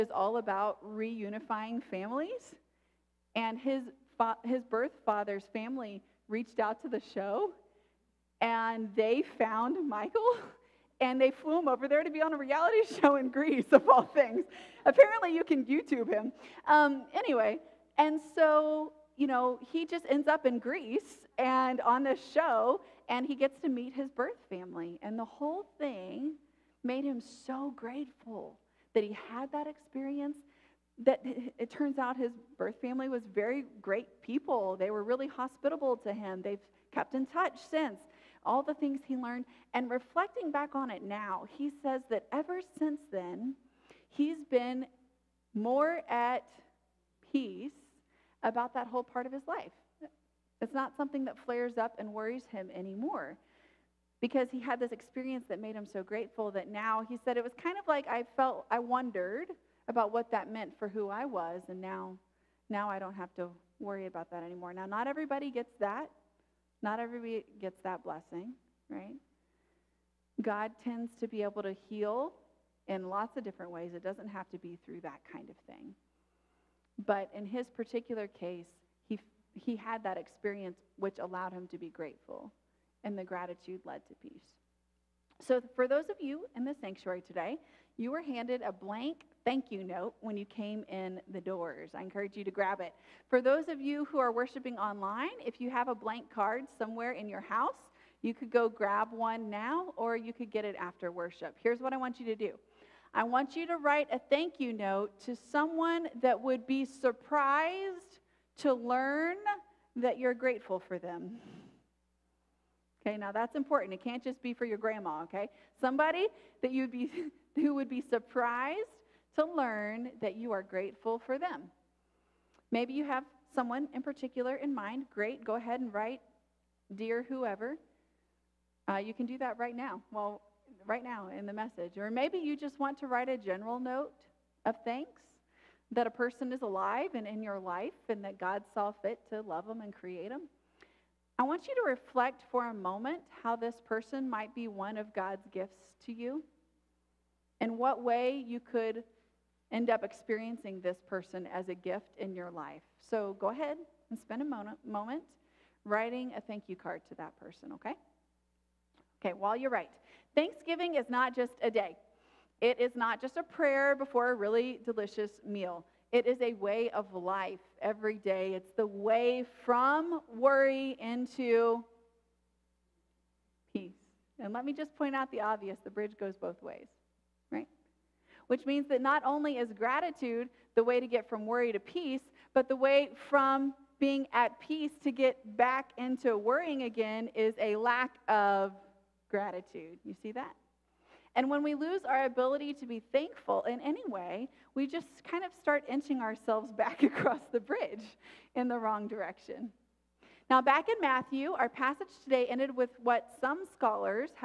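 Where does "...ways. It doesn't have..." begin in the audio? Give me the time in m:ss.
1:13.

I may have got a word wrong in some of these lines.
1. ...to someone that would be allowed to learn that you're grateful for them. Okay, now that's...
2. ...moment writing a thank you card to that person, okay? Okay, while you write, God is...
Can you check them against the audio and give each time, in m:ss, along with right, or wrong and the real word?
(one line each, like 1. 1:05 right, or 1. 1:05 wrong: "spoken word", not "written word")
1. 1:45 wrong: "surprised", not "allowed"
2. 2:34 wrong: "Thanksgiving", not "God".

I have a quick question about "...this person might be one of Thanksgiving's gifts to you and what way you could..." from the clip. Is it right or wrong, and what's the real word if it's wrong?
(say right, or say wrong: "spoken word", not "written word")
wrong: "God", not "Thanksgiving".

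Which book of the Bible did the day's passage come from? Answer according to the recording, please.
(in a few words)
Matthew.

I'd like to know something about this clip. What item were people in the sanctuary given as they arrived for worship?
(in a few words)
A blank thank you note.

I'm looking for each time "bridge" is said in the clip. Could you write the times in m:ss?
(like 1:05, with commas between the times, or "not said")
2:55, 3:17.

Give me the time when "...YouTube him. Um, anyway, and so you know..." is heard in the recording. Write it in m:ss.
0:15.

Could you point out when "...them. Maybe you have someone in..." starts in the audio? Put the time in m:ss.
2:01.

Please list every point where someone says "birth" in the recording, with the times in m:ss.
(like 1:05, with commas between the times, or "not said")
0:04, 0:24, 0:32.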